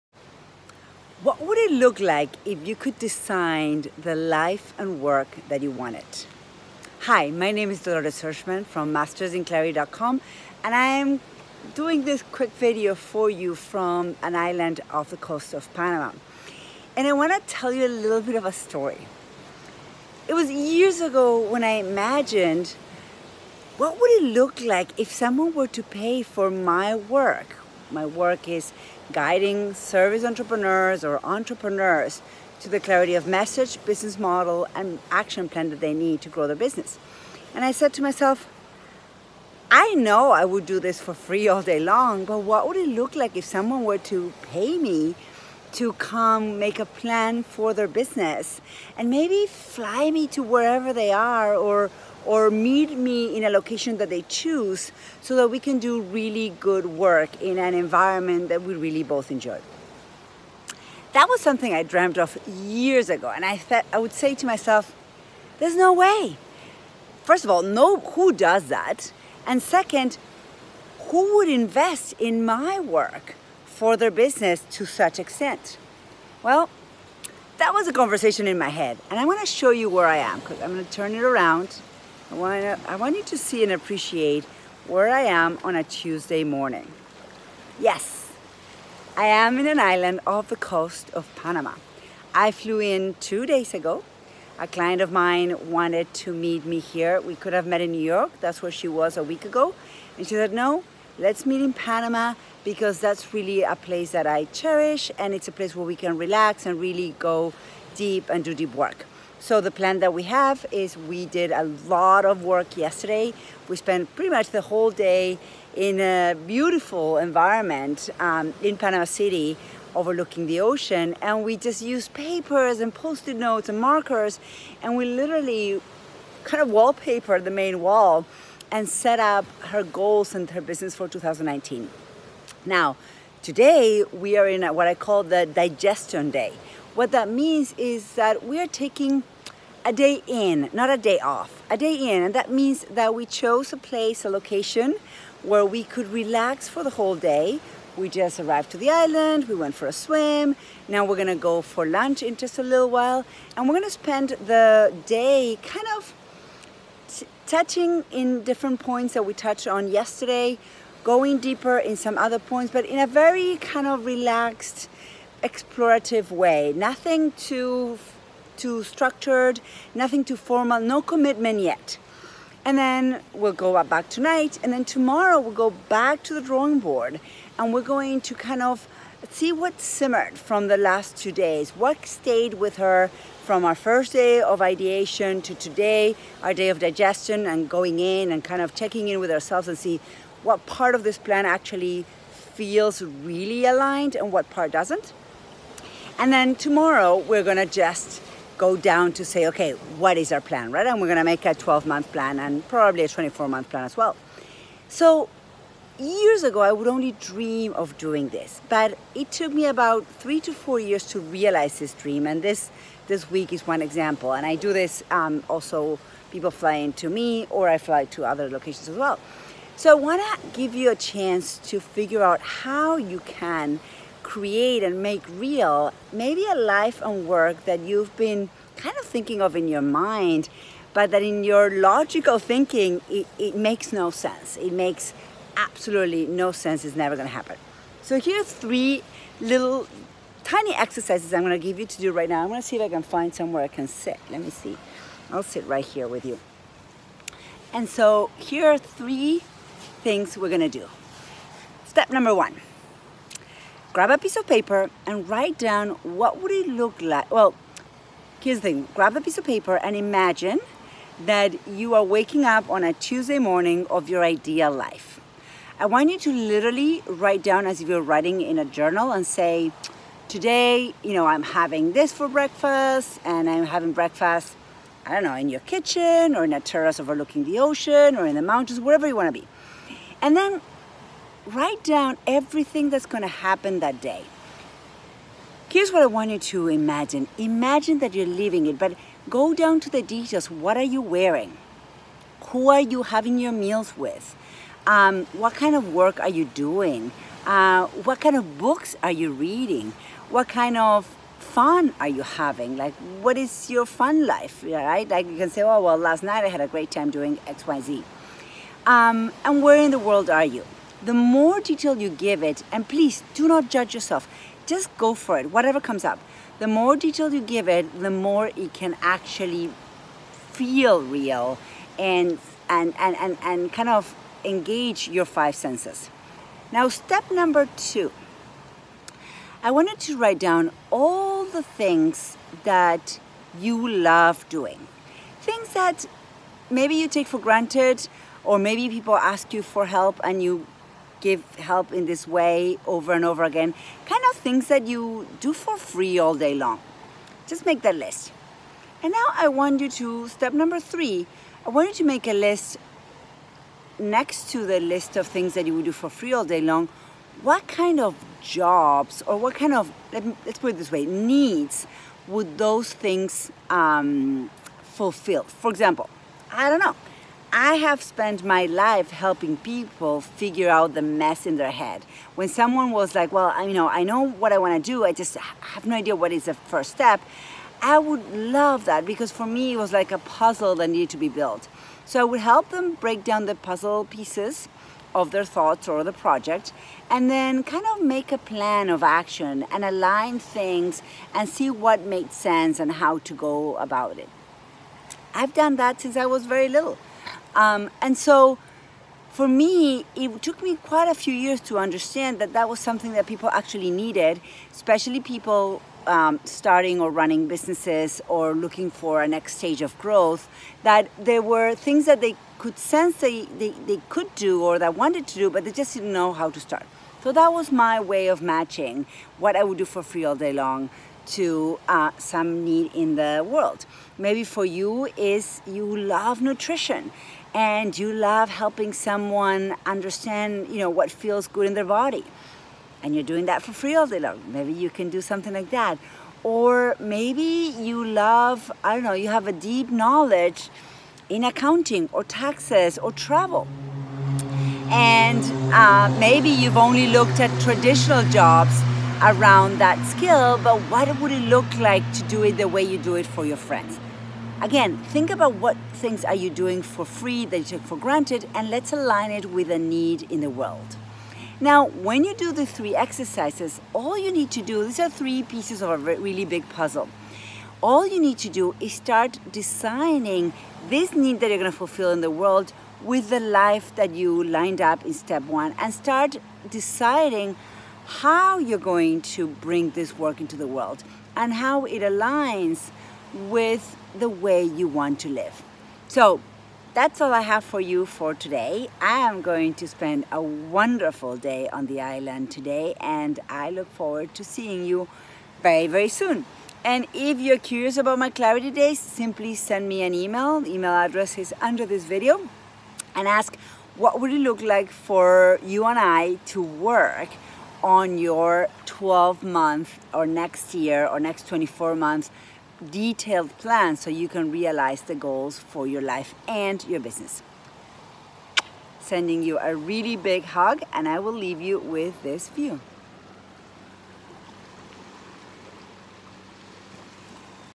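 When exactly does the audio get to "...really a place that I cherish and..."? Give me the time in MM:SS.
01:43.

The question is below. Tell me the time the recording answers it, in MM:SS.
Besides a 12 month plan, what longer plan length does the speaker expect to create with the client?
03:23.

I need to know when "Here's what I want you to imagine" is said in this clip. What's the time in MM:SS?
04:45.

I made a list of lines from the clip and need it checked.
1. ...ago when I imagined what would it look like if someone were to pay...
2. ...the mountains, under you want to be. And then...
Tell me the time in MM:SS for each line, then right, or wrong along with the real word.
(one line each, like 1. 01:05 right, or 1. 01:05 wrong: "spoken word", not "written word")
1. 00:21 right
2. 04:38 wrong: "wherever", not "under".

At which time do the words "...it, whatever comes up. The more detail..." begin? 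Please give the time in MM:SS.
05:15.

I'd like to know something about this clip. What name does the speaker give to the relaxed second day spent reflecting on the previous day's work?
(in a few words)
digestion day.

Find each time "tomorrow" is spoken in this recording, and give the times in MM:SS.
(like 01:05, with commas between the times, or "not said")
02:54, 03:16.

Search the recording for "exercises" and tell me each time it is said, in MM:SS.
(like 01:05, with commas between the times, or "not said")
04:00, 07:42.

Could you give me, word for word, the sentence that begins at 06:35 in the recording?
I've done that since I was very little.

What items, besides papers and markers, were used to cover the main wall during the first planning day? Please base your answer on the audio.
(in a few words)
post-it notes.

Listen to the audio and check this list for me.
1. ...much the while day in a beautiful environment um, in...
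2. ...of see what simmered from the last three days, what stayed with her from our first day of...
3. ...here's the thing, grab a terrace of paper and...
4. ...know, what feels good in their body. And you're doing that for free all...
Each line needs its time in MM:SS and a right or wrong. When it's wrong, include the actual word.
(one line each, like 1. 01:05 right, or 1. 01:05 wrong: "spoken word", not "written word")
1. 01:54 wrong: "whole", not "while"
2. 02:58 wrong: "two", not "three"
3. 04:18 wrong: "piece", not "terrace"
4. 07:10 right.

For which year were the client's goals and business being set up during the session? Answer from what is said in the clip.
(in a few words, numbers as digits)
2019.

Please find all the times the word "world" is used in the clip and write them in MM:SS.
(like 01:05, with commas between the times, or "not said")
05:09, 07:03, 07:40, 07:52, 08:00.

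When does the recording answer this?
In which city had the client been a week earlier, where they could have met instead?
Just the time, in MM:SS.
01:37.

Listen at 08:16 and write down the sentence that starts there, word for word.
And if you're curious about my clarity days, simply send me an email.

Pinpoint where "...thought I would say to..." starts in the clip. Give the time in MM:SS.
01:03.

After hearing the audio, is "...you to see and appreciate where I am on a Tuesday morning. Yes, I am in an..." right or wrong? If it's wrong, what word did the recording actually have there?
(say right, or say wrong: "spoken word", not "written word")
right.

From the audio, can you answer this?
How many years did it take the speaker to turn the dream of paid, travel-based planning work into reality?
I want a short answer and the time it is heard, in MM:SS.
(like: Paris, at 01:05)
3 to 4 years, at 03:30.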